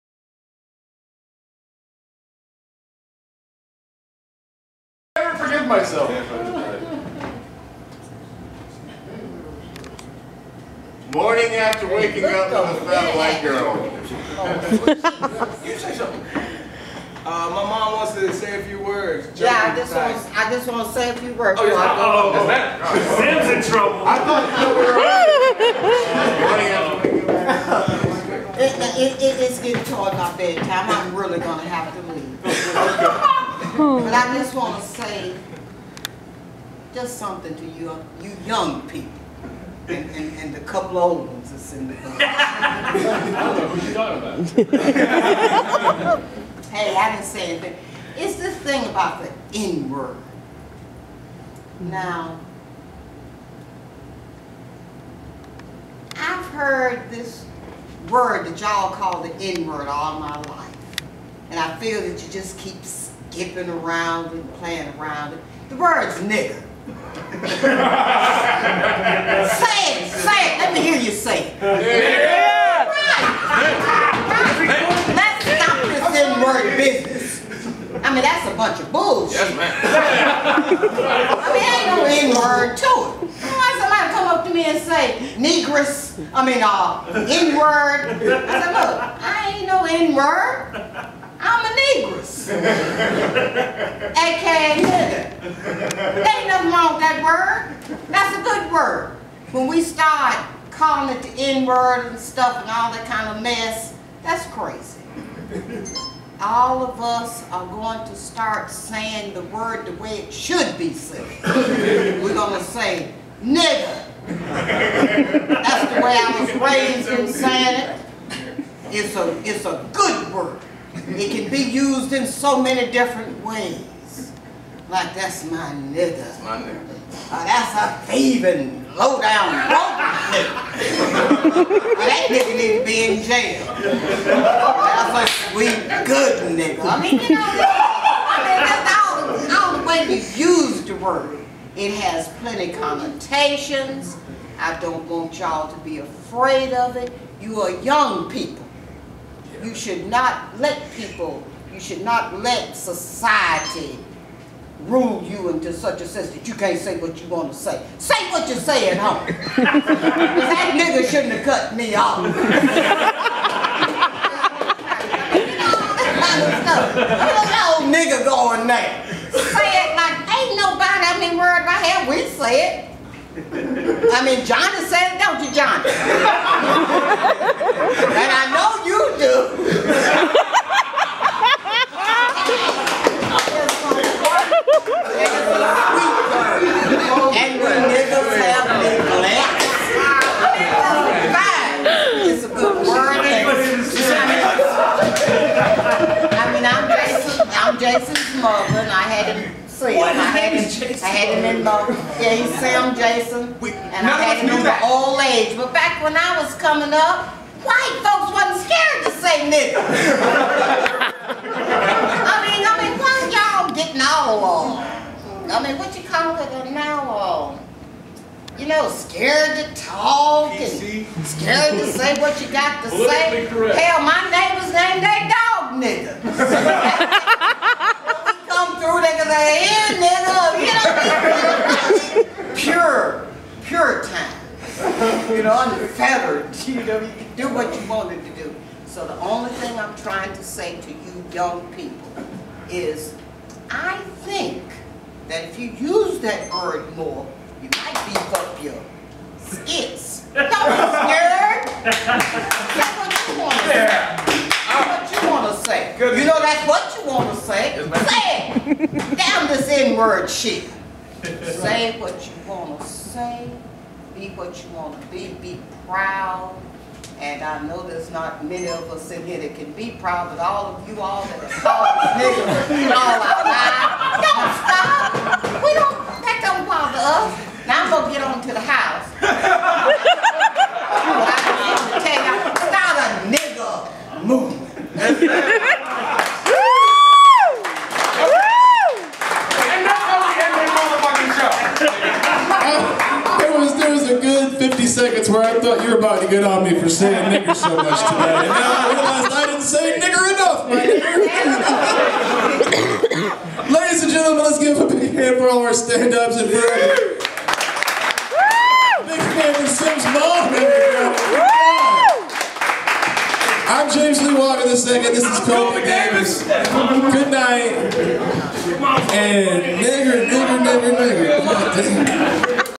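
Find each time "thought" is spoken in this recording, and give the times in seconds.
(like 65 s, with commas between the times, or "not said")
24 s, 295 s.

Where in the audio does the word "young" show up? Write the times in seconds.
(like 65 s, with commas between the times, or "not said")
38 s, 147 s, 241 s.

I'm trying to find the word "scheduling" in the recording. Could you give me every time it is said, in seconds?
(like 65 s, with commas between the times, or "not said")
not said.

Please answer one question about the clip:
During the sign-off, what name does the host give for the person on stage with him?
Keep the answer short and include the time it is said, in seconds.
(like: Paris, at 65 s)
Kobe Davis, at 315 s.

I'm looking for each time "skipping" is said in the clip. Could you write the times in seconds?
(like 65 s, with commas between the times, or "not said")
62 s.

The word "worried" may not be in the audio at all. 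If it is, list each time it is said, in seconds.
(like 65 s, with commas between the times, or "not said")
171 s.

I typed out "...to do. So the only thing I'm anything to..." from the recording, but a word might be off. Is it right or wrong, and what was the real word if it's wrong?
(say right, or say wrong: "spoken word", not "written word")
wrong: "trying", not "anything".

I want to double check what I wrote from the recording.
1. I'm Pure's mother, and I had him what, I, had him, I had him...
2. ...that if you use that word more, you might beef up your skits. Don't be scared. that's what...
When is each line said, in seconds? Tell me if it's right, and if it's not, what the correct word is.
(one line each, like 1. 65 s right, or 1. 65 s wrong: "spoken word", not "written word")
1. 197 s wrong: "Jason", not "Pure"
2. 245 s right.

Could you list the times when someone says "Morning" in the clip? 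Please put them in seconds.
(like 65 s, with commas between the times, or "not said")
11 s, 27 s.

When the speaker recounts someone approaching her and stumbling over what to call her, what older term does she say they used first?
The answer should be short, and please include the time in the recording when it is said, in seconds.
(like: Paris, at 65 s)
negress, at 85 s.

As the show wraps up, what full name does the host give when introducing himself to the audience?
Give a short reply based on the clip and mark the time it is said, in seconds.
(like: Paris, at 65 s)
James Lee Walker the second, at 313 s.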